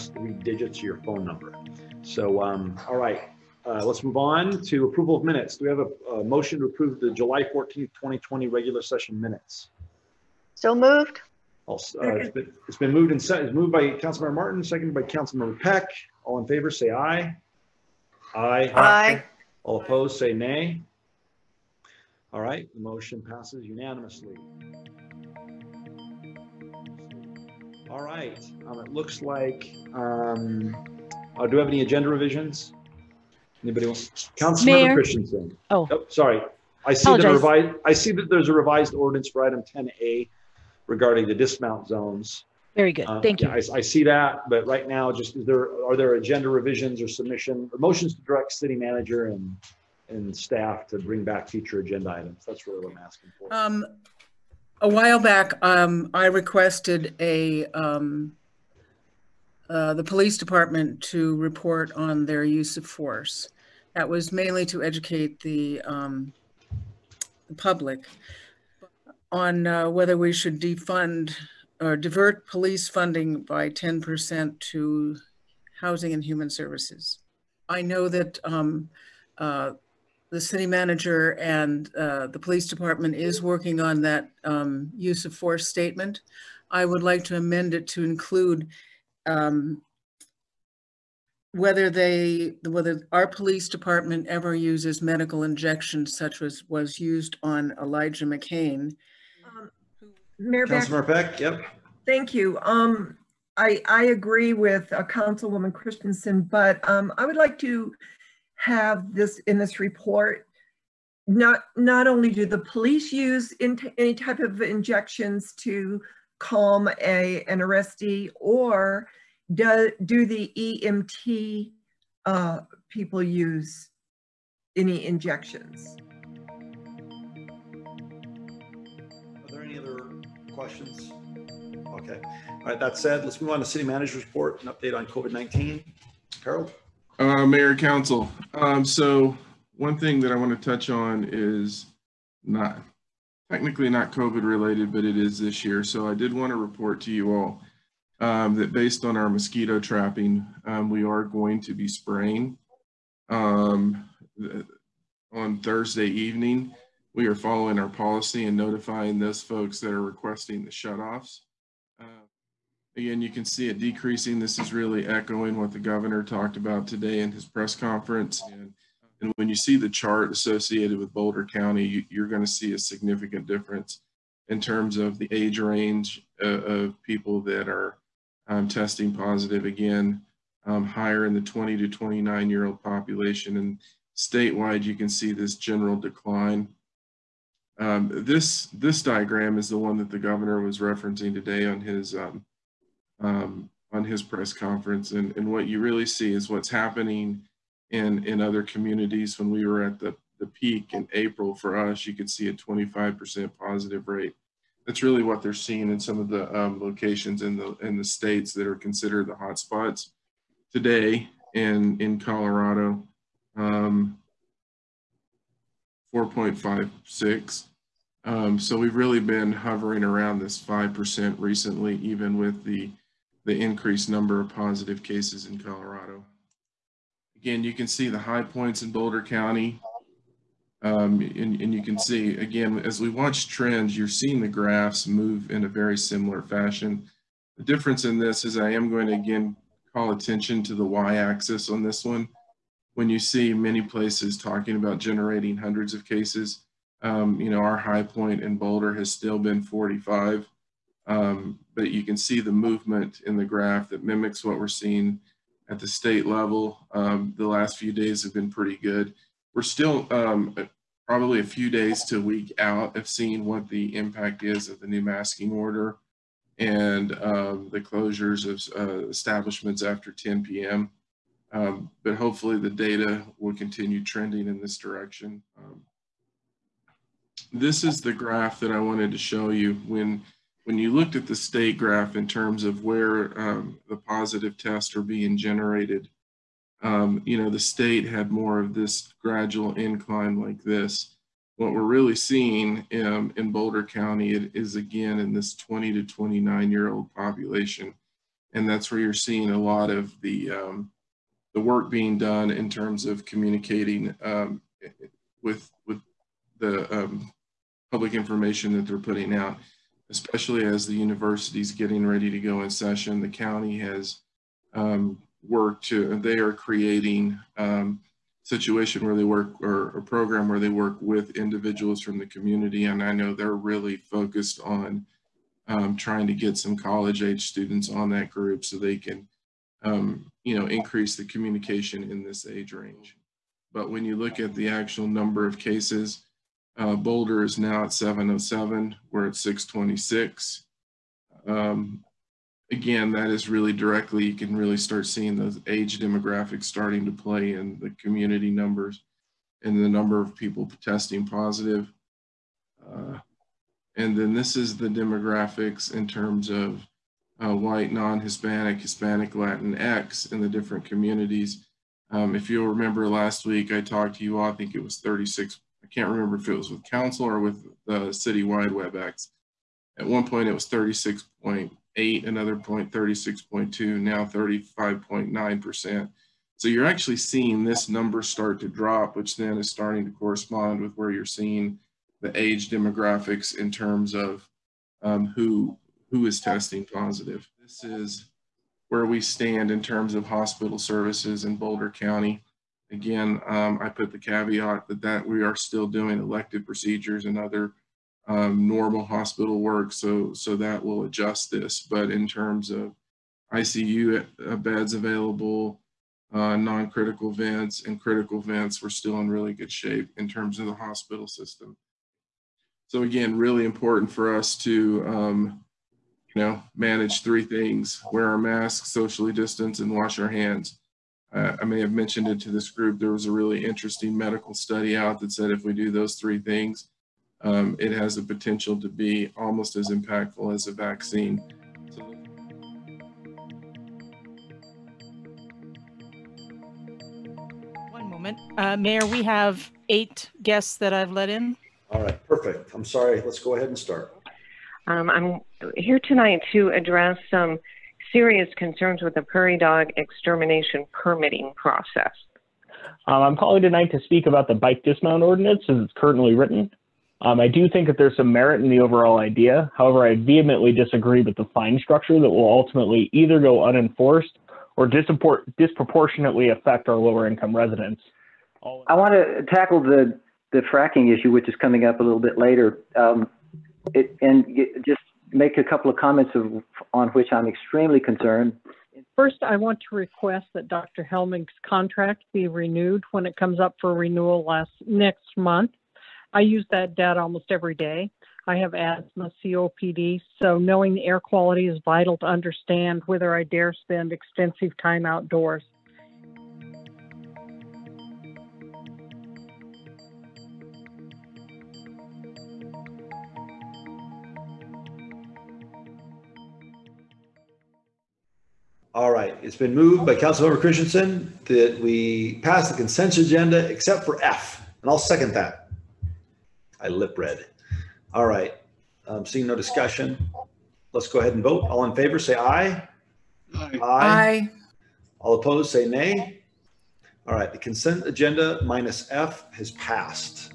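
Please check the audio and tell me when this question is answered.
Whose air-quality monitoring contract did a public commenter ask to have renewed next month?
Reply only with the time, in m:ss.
8:00.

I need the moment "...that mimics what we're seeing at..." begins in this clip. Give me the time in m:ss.
4:13.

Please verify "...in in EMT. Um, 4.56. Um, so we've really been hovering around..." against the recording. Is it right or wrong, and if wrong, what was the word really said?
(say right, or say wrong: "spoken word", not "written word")
wrong: "Colorado", not "EMT".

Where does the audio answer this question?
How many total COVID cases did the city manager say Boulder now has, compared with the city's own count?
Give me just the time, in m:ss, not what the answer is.
5:37.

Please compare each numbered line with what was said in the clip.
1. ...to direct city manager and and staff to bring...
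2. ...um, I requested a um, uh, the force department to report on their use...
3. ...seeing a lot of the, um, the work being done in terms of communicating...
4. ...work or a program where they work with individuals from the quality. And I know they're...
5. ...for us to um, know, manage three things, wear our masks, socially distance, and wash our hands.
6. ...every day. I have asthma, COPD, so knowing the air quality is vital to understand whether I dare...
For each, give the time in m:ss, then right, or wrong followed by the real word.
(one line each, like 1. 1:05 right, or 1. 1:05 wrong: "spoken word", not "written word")
1. 0:48 right
2. 0:55 wrong: "police", not "force"
3. 4:59 right
4. 5:19 wrong: "community", not "quality"
5. 6:54 right
6. 8:07 right.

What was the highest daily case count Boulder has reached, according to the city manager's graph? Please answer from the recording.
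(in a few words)
45.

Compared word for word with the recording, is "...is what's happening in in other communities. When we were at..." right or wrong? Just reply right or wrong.
right.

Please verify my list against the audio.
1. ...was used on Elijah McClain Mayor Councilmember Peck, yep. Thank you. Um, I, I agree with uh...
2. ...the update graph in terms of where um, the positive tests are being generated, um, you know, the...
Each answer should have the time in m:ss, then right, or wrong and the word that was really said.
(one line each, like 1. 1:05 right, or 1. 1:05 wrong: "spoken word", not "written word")
1. 1:36 right
2. 4:41 wrong: "state", not "update".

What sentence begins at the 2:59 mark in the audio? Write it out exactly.
Again, um, higher in the 20 to 29 year old population.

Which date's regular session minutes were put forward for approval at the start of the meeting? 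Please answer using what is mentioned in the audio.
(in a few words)
July 14th, 2020.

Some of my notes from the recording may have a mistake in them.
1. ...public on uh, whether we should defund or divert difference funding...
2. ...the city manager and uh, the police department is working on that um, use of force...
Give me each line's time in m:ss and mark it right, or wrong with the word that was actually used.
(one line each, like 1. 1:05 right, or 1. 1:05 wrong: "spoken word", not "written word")
1. 1:07 wrong: "police", not "difference"
2. 1:20 right.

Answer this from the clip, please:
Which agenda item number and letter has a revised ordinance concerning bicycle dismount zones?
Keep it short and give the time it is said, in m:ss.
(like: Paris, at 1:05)
10A, at 0:39.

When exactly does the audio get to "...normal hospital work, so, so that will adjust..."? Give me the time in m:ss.
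6:38.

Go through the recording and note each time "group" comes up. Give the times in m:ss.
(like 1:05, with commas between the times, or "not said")
5:28, 7:02.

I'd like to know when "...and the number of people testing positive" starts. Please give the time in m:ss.
5:49.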